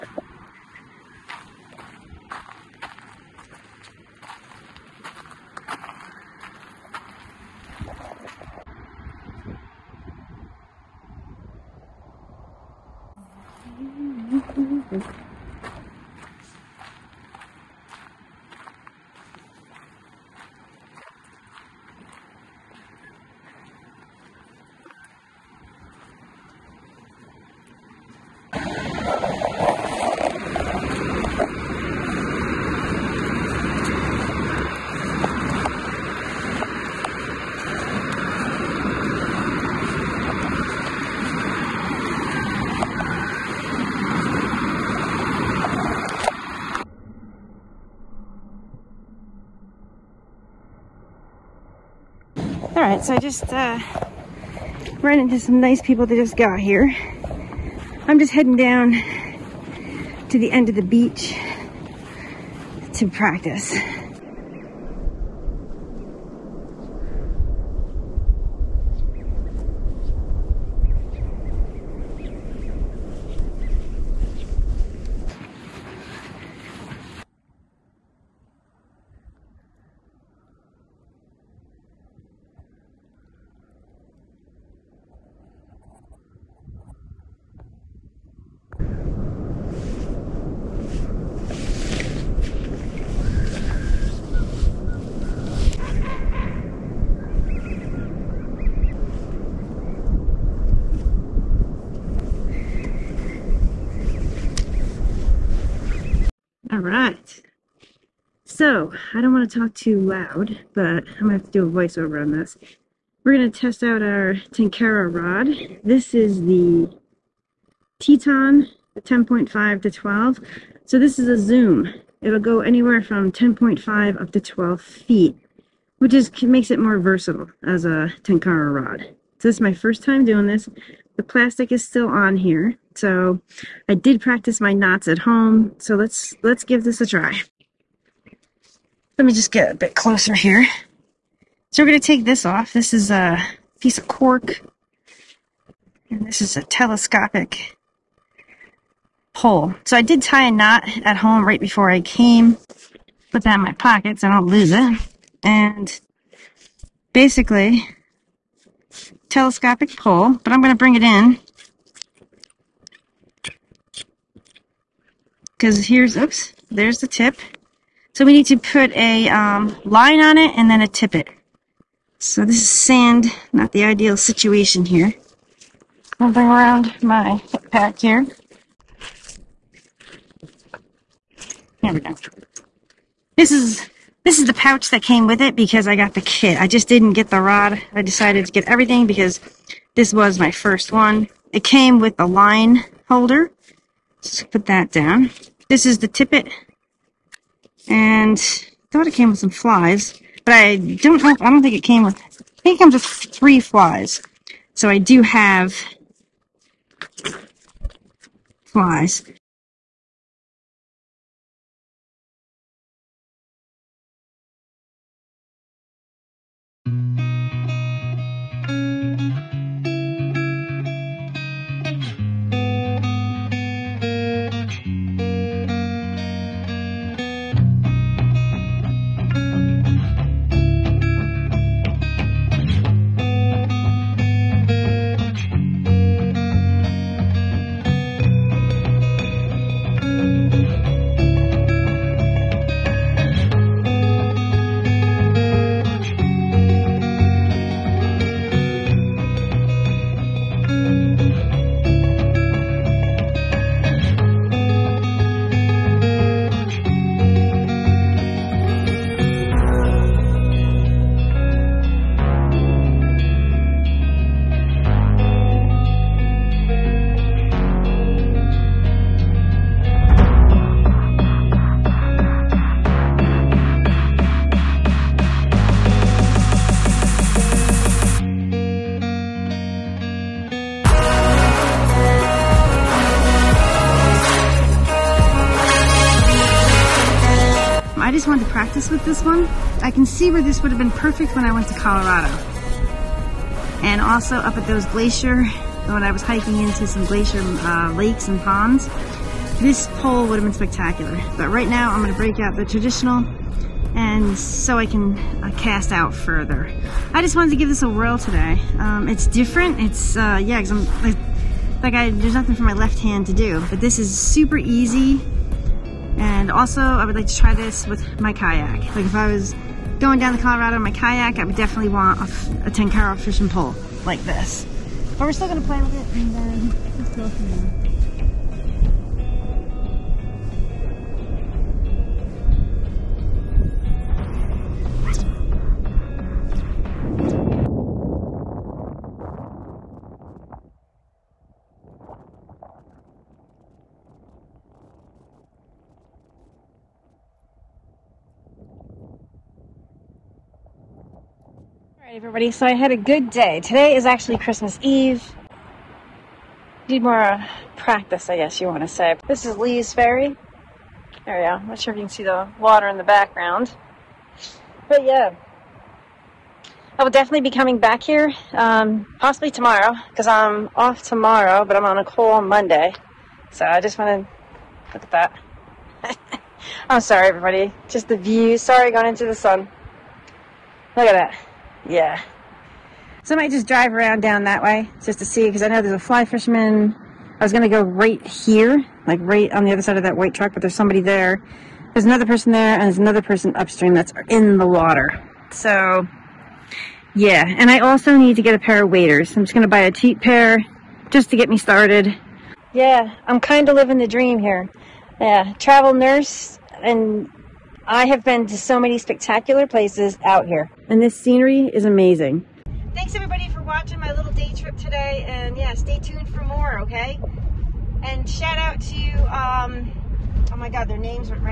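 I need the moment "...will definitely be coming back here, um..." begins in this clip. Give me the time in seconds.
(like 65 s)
367 s.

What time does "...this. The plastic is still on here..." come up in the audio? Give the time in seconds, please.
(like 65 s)
130 s.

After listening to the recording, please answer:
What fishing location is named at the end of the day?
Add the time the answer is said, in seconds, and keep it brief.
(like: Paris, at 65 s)
Lee's Ferry, at 359 s.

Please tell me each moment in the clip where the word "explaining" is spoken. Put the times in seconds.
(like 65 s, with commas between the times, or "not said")
not said.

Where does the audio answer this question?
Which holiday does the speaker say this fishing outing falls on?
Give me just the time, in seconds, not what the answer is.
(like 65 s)
354 s.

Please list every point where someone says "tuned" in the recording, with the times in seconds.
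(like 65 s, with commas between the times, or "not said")
415 s.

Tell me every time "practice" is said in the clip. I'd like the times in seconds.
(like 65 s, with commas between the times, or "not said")
63 s, 134 s, 357 s.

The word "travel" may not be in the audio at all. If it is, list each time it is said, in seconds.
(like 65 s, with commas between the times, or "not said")
405 s.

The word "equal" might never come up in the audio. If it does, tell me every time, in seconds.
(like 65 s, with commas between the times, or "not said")
not said.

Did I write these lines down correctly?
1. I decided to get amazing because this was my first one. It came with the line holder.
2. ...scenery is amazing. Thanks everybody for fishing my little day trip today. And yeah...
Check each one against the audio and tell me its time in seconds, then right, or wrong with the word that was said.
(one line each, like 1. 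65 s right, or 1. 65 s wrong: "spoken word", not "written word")
1. 187 s wrong: "everything", not "amazing"
2. 411 s wrong: "watching", not "fishing".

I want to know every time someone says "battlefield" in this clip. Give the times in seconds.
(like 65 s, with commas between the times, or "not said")
not said.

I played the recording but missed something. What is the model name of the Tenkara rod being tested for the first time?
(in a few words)
Teton.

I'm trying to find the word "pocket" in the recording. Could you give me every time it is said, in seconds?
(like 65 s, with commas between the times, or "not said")
153 s.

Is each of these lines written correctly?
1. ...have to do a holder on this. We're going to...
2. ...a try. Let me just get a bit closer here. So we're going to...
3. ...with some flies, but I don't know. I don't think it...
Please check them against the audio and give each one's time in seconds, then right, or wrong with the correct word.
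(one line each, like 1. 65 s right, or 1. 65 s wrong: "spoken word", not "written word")
1. 111 s wrong: "voiceover", not "holder"
2. 137 s right
3. 199 s right.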